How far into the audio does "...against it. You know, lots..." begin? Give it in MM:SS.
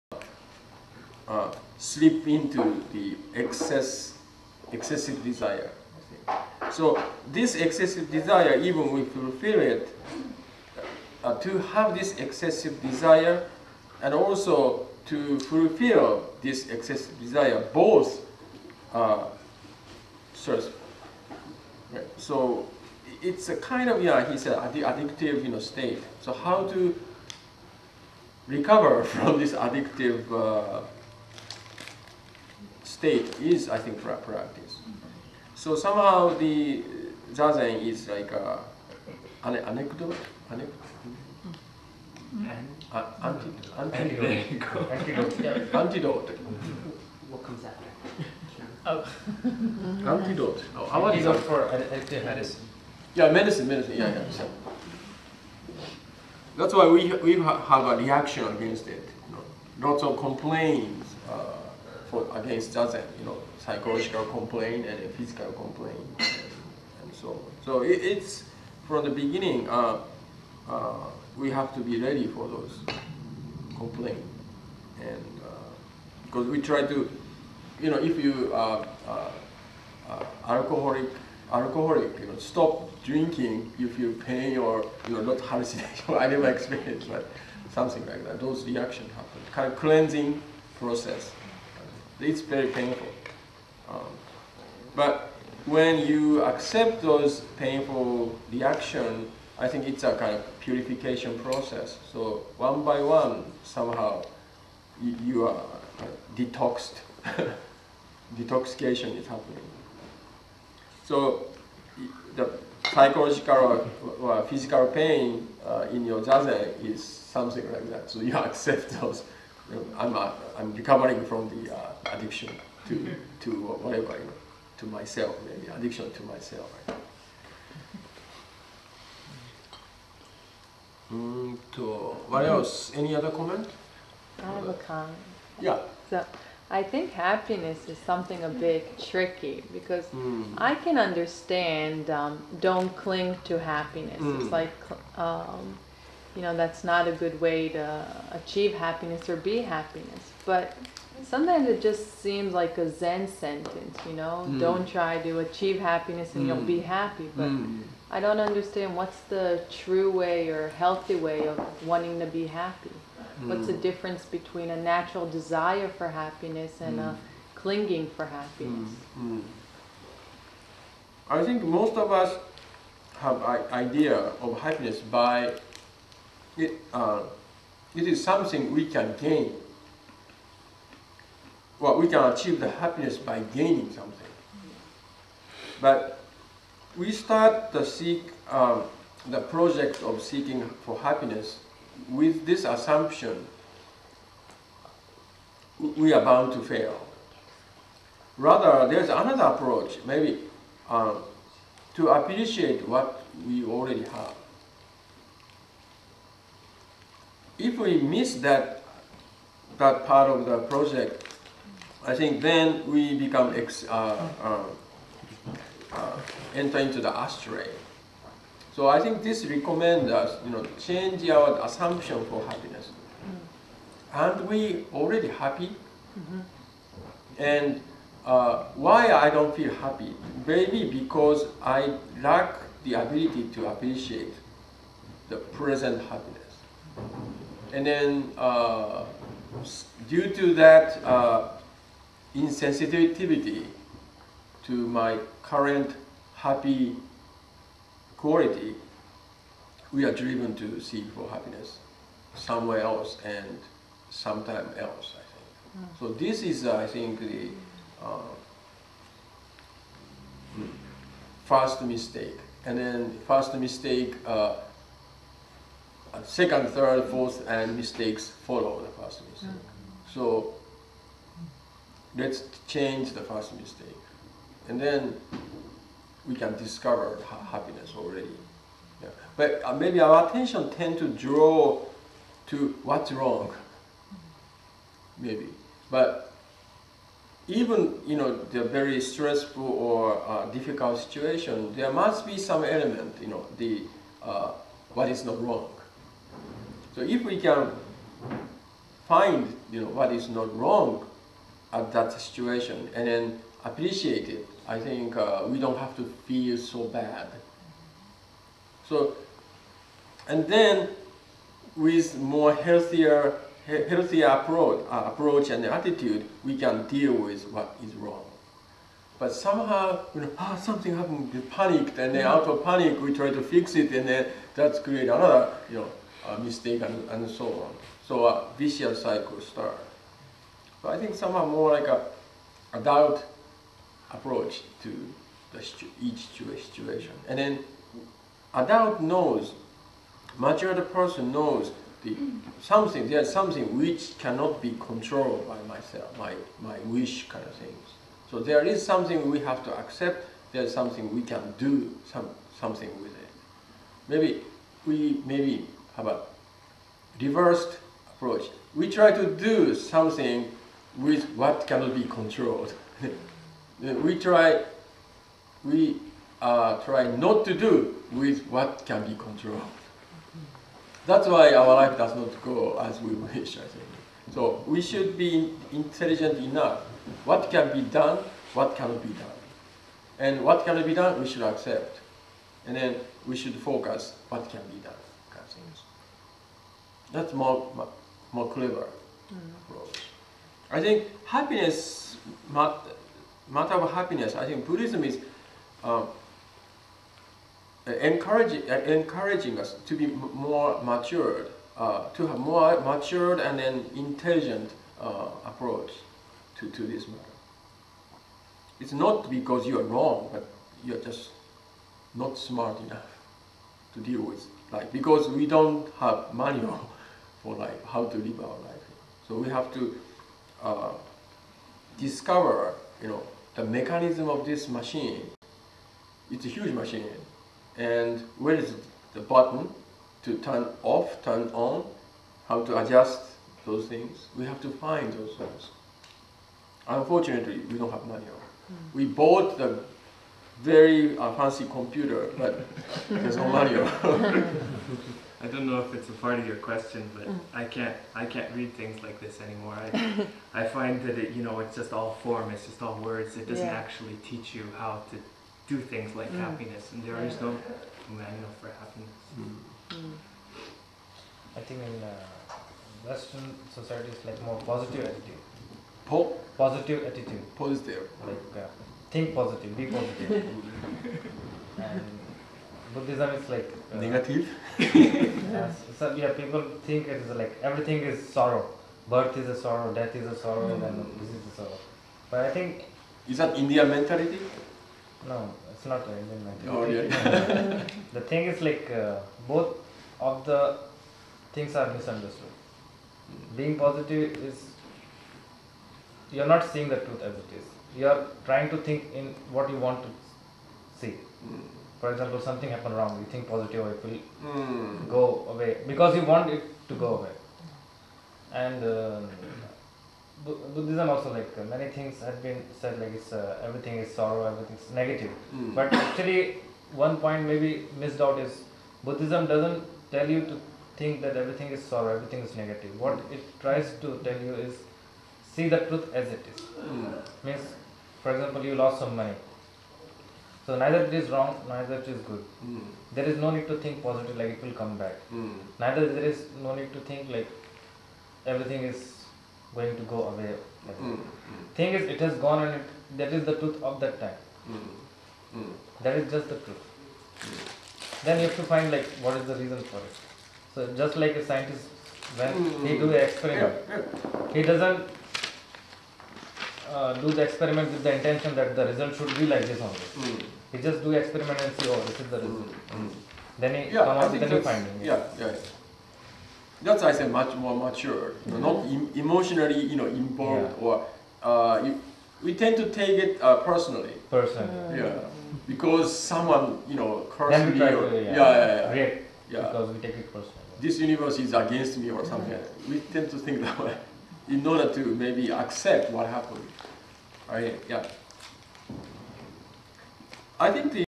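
00:58.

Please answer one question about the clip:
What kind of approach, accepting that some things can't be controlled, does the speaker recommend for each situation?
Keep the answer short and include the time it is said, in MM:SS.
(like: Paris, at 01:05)
Adult approach, at 05:32.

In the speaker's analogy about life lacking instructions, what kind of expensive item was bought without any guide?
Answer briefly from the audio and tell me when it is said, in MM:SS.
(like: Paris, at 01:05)
Fancy computer, at 07:21.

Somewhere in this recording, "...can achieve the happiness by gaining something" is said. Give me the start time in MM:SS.
03:02.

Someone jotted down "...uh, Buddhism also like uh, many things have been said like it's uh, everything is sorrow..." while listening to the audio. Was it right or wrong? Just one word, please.
right.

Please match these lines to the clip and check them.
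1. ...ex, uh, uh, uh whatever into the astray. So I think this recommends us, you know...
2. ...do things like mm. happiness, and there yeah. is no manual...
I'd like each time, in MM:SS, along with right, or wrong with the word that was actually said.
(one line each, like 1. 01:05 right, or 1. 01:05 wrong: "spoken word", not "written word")
1. 03:33 wrong: "enter", not "whatever"
2. 07:35 right.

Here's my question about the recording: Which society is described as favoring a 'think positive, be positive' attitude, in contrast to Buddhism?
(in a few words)
Western society.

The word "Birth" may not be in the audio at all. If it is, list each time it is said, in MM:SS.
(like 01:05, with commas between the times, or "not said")
07:59.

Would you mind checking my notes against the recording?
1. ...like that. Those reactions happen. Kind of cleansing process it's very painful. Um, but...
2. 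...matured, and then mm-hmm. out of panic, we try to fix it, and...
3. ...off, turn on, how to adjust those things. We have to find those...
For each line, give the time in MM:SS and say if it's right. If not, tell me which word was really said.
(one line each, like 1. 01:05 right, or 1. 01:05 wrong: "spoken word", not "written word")
1. 01:28 right
2. 05:21 wrong: "panicked", not "matured"
3. 07:10 right.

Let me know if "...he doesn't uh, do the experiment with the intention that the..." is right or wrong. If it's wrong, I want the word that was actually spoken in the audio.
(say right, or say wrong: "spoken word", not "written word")
right.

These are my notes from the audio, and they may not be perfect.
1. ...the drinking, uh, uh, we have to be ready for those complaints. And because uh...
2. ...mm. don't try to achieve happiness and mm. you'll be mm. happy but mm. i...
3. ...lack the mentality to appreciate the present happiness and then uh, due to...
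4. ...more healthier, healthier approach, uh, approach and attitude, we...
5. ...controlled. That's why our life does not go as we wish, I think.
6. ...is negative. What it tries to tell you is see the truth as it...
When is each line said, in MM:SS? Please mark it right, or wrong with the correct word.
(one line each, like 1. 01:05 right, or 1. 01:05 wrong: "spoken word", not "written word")
1. 01:09 wrong: "beginning", not "drinking"
2. 02:34 right
3. 03:52 wrong: "ability", not "mentality"
4. 05:12 right
5. 06:09 right
6. 08:42 right.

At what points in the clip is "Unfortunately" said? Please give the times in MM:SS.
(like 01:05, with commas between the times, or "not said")
07:16.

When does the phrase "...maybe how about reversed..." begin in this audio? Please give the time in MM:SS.
05:55.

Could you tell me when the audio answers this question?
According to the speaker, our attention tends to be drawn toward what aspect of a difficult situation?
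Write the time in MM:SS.
04:42.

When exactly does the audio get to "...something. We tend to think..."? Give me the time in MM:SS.
09:42.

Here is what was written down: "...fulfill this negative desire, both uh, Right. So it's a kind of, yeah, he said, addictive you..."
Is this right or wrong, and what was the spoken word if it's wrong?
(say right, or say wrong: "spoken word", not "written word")
wrong: "excessive", not "negative".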